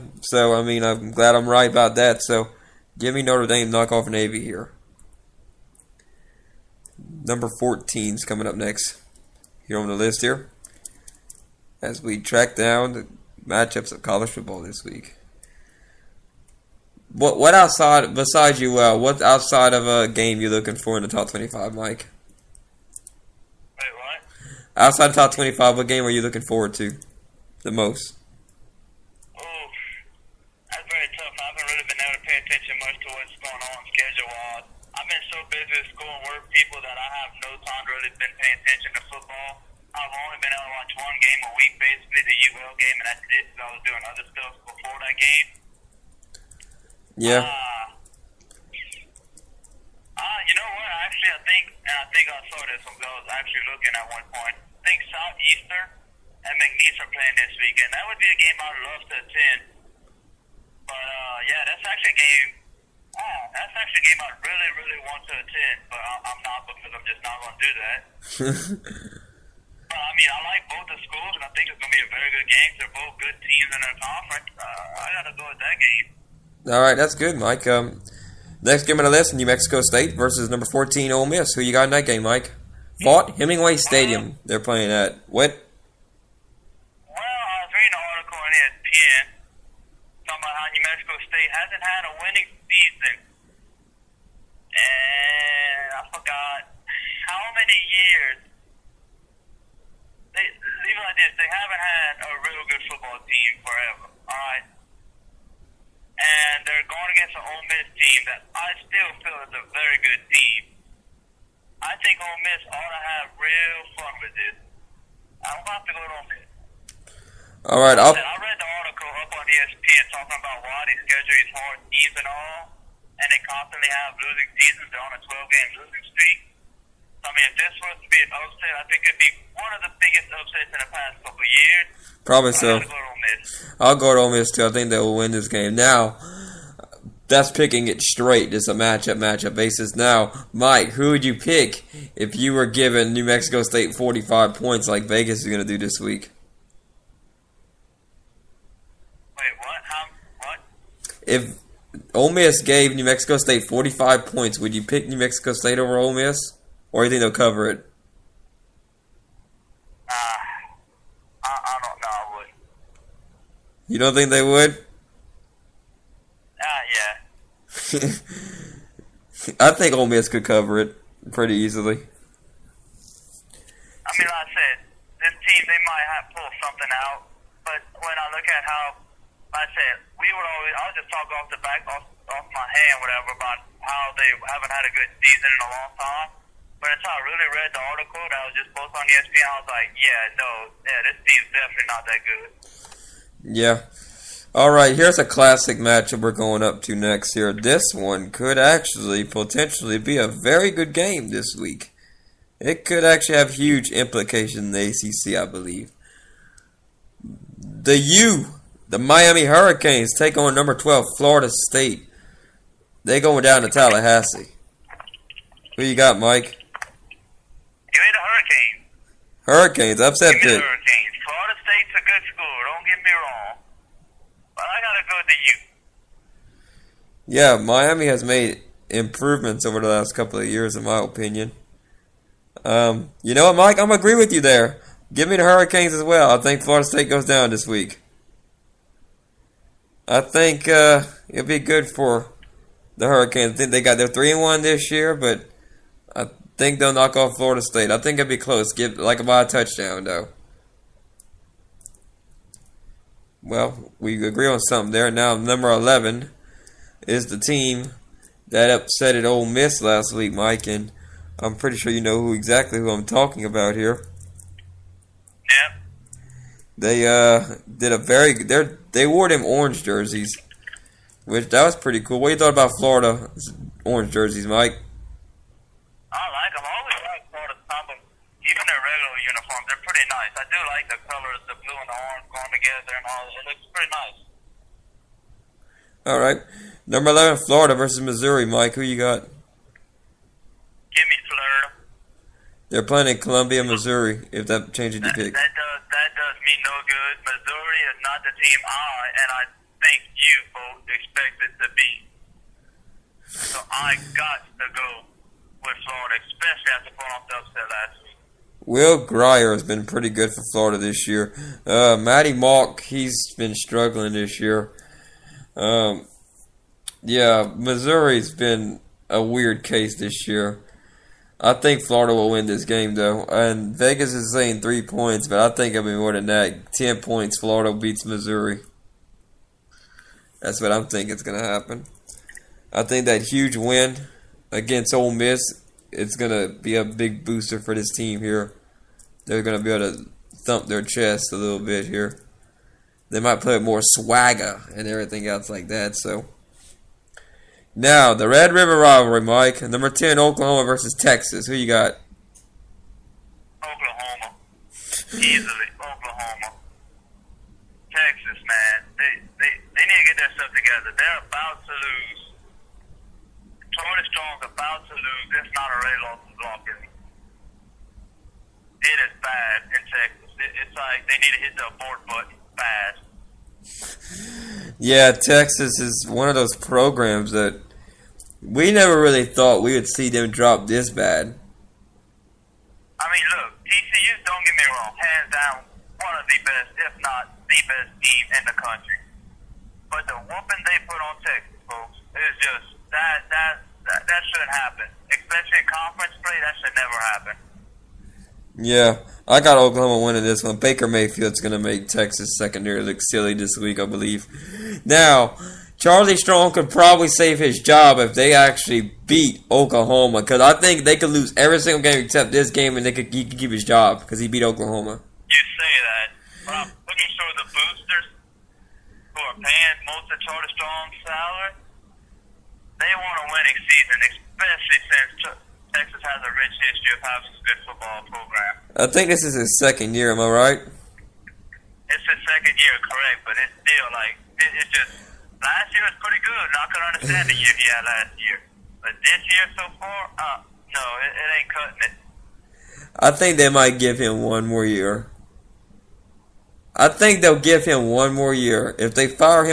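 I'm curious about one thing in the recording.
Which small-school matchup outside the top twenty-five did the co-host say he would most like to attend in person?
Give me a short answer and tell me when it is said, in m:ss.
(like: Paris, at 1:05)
Southeastern and McNeese, at 0:55.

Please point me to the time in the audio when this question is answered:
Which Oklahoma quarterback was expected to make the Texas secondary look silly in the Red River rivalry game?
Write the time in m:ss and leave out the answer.
6:40.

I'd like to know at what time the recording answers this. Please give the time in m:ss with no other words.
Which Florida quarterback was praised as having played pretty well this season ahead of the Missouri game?
5:08.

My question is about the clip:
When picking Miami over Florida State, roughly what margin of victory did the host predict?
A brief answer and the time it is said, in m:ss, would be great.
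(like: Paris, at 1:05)
About a touchdown, at 4:09.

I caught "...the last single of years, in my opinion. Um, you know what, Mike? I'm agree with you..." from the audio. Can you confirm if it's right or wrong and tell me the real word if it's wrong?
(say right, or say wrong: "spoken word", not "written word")
wrong: "couple", not "single".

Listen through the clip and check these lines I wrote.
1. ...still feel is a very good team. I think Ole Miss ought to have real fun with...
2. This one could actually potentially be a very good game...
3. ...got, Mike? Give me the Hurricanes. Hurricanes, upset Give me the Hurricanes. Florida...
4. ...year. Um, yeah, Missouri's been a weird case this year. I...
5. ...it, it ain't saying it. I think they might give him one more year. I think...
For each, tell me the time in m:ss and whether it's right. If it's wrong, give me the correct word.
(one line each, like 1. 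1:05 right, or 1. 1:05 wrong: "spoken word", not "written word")
1. 1:48 right
2. 3:17 right
3. 3:35 right
4. 5:14 right
5. 7:21 wrong: "cutting", not "saying".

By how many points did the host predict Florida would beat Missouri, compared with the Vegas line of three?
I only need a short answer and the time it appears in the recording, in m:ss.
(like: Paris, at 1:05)
10, at 5:26.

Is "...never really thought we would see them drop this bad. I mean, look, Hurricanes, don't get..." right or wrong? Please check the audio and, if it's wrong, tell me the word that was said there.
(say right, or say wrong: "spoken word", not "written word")
wrong: "TCU", not "Hurricanes".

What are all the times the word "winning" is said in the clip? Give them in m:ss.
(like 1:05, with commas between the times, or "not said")
1:32, 6:40, 7:03.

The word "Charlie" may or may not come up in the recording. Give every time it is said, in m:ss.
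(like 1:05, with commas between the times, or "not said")
6:45, 7:00.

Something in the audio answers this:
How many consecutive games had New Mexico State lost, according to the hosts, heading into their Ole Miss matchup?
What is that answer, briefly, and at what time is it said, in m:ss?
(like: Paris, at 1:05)
12, at 2:05.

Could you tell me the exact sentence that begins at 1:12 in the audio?
They're both good teams in their conference.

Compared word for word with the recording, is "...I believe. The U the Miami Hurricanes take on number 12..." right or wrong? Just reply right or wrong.
right.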